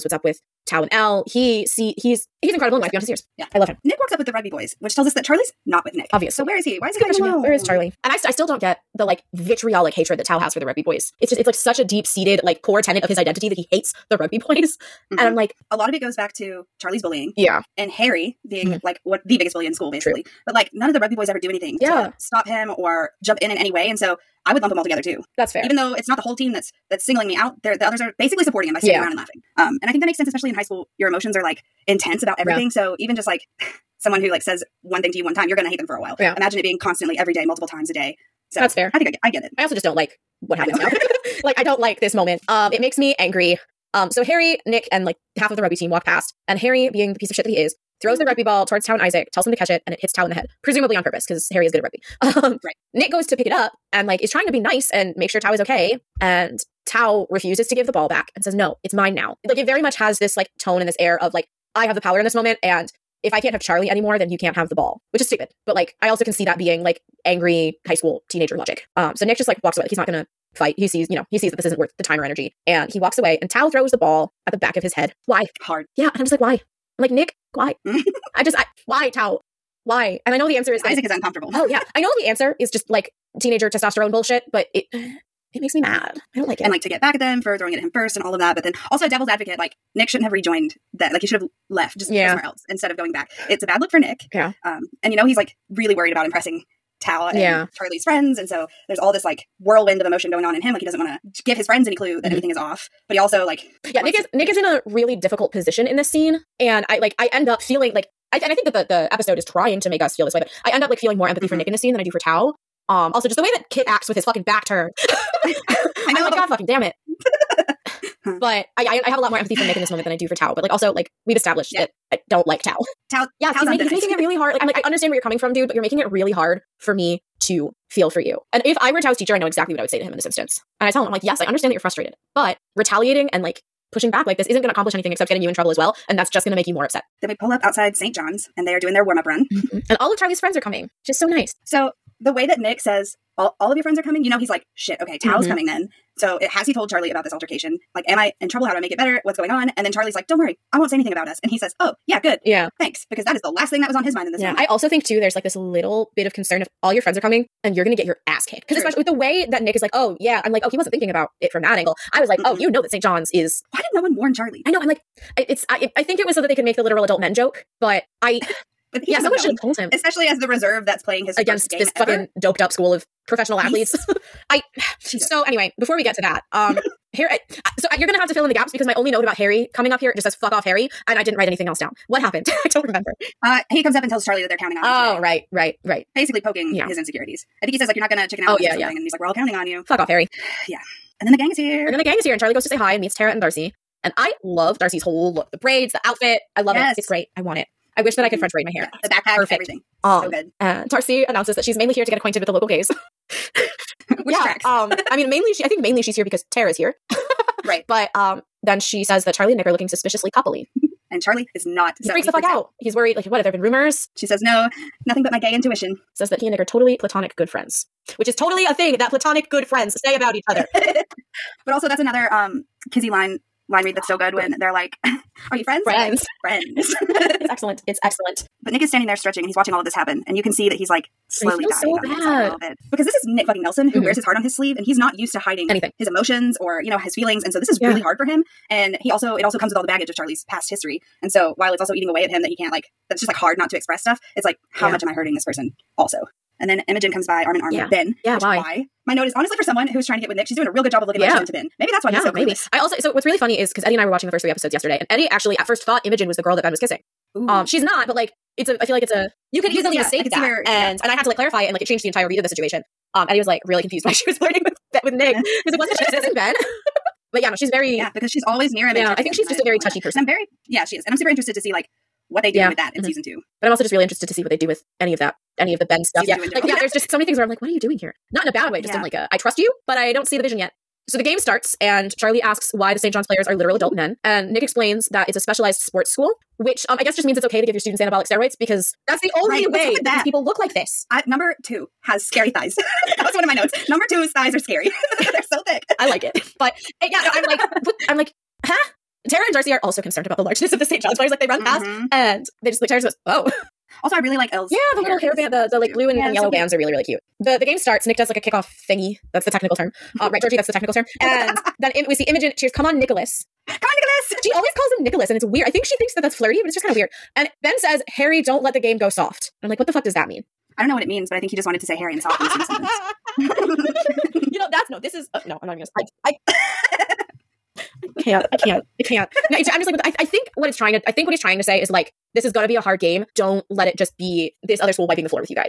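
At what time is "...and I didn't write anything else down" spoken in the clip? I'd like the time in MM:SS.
03:01.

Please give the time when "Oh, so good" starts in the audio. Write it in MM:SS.
03:20.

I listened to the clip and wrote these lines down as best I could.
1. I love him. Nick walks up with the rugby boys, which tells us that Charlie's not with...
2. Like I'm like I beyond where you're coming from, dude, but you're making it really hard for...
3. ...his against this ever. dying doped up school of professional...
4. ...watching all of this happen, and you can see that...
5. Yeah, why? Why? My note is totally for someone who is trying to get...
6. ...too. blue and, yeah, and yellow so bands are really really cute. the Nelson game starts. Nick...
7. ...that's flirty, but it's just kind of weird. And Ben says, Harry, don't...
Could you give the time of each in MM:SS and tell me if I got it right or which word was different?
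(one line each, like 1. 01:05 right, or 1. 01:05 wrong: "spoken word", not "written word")
1. 00:03 right
2. 02:04 wrong: "understand", not "beyond"
3. 02:51 wrong: "fucking", not "dying"
4. 03:49 right
5. 04:08 wrong: "honestly", not "totally"
6. 05:05 wrong: "The", not "Nelson"
7. 05:16 right.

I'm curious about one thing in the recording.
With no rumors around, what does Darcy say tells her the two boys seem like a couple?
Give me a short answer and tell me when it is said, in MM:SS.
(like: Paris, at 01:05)
gay intuition, at 03:35.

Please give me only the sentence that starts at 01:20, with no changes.
And I know the answer is Isaac it, is uncomfortable.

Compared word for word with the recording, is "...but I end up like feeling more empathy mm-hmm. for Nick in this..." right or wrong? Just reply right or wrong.
right.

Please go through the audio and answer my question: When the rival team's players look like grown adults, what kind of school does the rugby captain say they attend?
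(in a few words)
specialized sports school.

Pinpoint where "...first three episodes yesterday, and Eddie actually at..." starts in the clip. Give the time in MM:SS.
04:14.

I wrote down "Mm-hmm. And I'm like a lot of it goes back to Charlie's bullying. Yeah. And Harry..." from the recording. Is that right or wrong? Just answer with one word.
right.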